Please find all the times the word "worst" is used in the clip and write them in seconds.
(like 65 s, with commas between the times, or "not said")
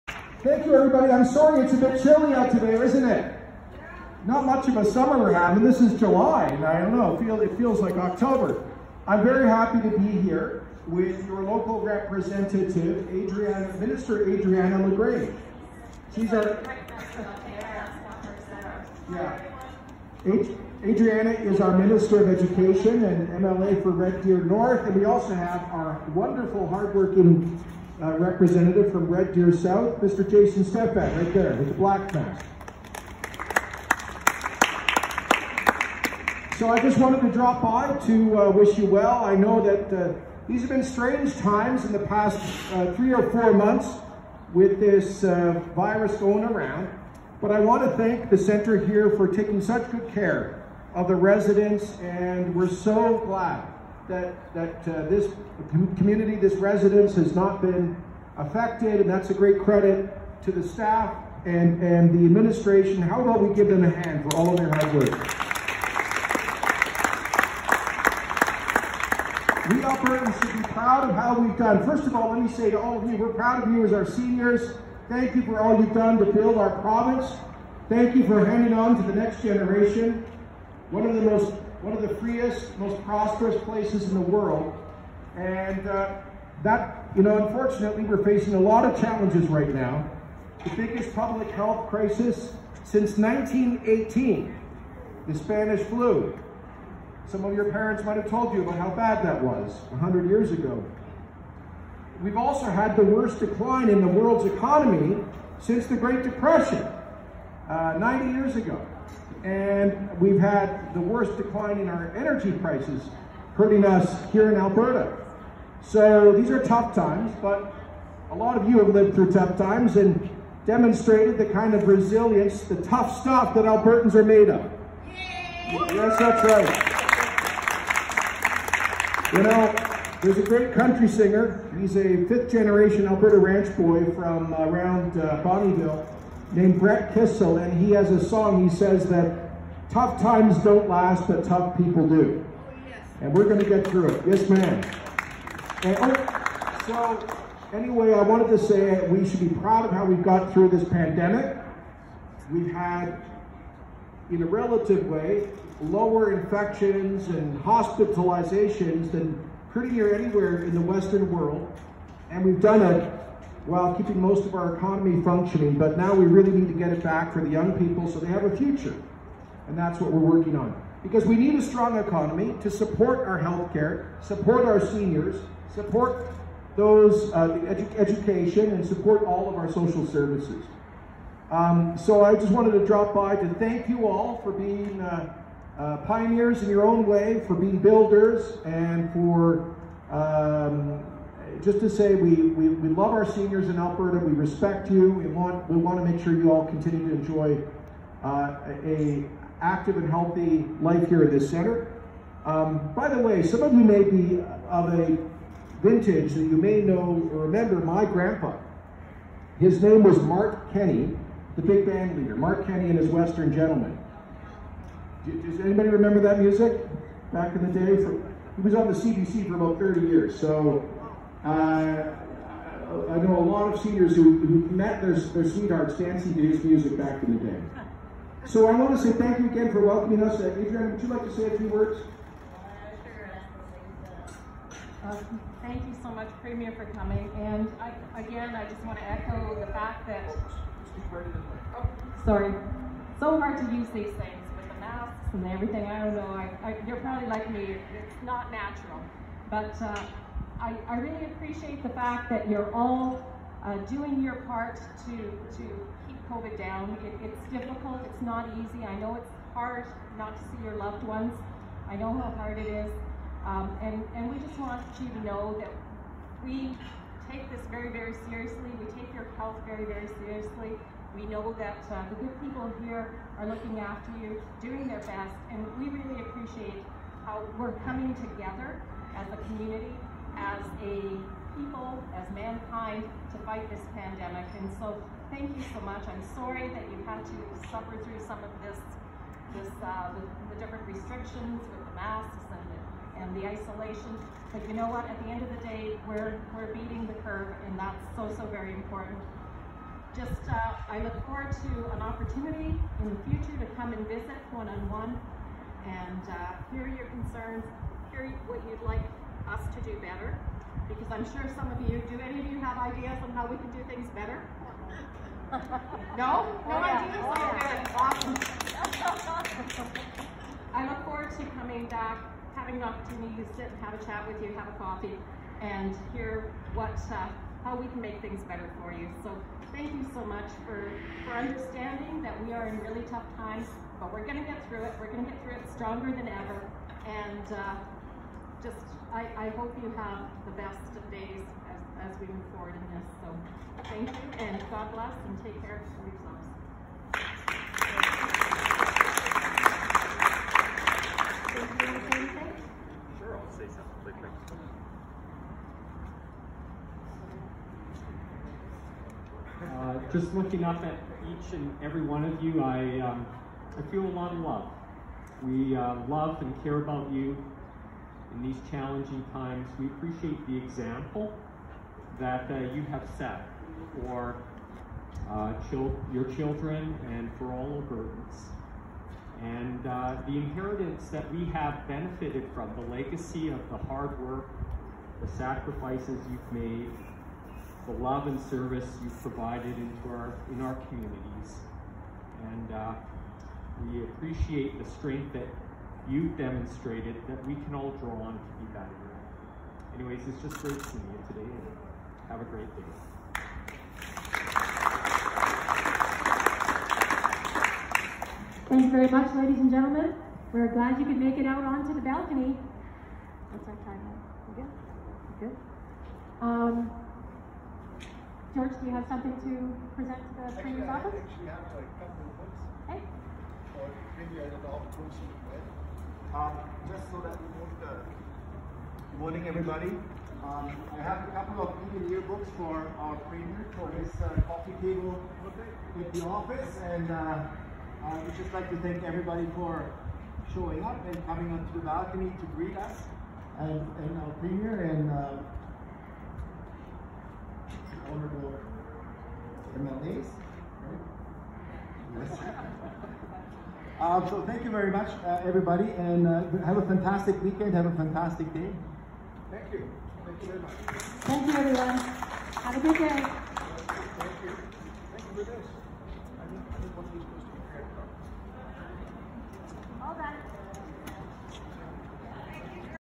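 103 s, 110 s.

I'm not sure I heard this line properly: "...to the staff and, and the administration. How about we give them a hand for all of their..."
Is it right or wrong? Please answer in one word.
right.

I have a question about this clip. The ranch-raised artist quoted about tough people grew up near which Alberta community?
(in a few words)
Bonnyville.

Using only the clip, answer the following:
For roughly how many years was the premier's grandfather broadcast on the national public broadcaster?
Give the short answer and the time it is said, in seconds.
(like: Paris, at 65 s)
30, at 219 s.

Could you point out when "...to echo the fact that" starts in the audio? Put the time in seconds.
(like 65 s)
238 s.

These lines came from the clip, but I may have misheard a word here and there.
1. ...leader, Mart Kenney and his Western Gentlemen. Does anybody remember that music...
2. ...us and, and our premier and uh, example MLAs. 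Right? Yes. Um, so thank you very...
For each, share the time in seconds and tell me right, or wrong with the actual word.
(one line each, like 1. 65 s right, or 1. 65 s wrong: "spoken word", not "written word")
1. 212 s right
2. 442 s wrong: "honorable", not "example".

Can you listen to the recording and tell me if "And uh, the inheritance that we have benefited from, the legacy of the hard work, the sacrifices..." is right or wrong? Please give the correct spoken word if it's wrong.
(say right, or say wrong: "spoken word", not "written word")
right.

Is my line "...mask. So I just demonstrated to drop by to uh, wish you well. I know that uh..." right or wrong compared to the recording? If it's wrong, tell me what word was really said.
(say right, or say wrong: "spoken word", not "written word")
wrong: "wanted", not "demonstrated".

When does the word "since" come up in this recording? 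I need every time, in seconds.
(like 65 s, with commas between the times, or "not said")
92 s, 105 s.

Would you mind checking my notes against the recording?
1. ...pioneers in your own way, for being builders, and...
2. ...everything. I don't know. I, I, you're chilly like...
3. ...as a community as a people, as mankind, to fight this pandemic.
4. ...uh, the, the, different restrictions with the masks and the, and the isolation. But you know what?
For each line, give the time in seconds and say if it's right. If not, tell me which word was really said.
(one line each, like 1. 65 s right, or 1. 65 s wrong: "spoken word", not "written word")
1. 186 s right
2. 245 s wrong: "probably", not "chilly"
3. 279 s right
4. 289 s right.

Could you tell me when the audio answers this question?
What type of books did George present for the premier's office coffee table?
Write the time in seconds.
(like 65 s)
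431 s.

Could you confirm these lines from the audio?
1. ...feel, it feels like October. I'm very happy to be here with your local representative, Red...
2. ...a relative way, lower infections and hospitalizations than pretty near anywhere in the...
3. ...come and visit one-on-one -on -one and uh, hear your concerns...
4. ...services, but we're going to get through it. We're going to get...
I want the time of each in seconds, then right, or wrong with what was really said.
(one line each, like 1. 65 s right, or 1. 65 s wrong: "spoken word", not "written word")
1. 7 s wrong: "Adriana", not "Red"
2. 154 s right
3. 303 s right
4. 333 s wrong: "times", not "services".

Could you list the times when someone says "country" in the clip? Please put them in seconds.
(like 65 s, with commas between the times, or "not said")
130 s.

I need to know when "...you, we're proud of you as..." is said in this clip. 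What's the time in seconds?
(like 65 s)
73 s.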